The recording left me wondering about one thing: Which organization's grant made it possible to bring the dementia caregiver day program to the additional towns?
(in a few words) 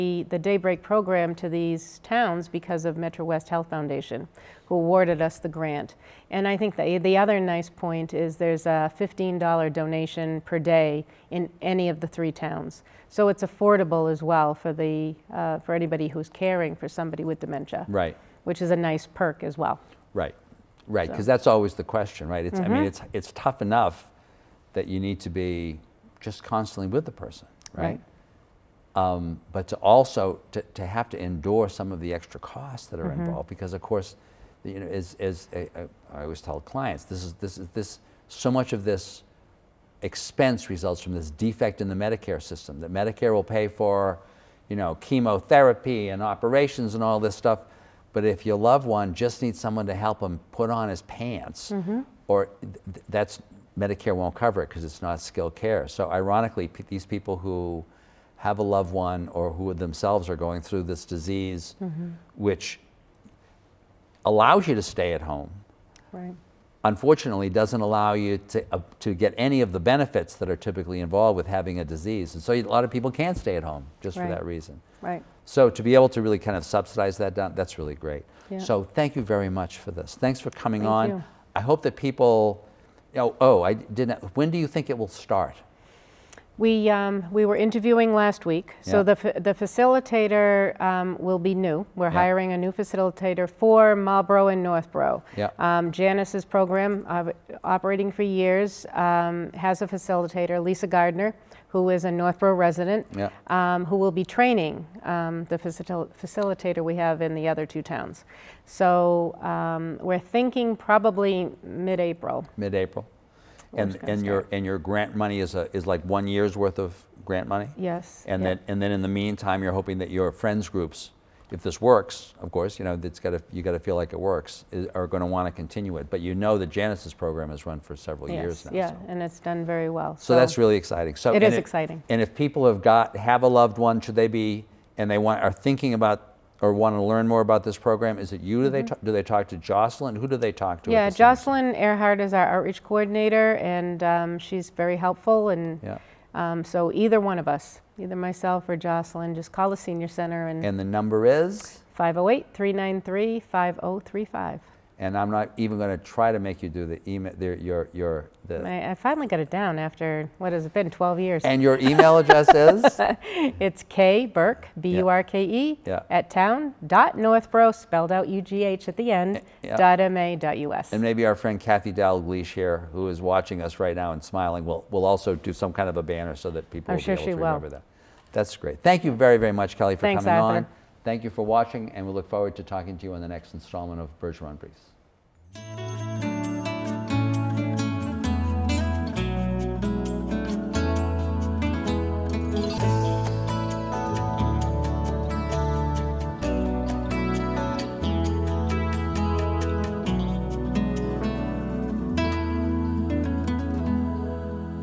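Metro West Health Foundation.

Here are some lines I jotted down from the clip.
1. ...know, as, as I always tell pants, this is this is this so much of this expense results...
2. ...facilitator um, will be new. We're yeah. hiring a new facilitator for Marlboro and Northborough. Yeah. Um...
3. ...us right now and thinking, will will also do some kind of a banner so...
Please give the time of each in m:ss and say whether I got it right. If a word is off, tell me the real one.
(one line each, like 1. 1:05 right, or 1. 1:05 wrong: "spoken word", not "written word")
1. 0:34 wrong: "clients", not "pants"
2. 1:29 right
3. 2:53 wrong: "smiling", not "thinking".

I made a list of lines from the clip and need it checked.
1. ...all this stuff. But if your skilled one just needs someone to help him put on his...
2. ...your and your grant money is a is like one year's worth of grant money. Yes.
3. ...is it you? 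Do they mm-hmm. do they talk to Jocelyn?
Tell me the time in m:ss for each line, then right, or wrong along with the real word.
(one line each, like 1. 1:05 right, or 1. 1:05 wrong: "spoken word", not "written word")
1. 0:47 wrong: "loved", not "skilled"
2. 1:54 right
3. 2:18 right.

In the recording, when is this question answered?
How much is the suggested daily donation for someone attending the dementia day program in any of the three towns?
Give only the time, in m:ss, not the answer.
0:08.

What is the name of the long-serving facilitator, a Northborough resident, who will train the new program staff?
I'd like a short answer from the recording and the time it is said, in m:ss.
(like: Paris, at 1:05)
Lisa Gardner, at 1:40.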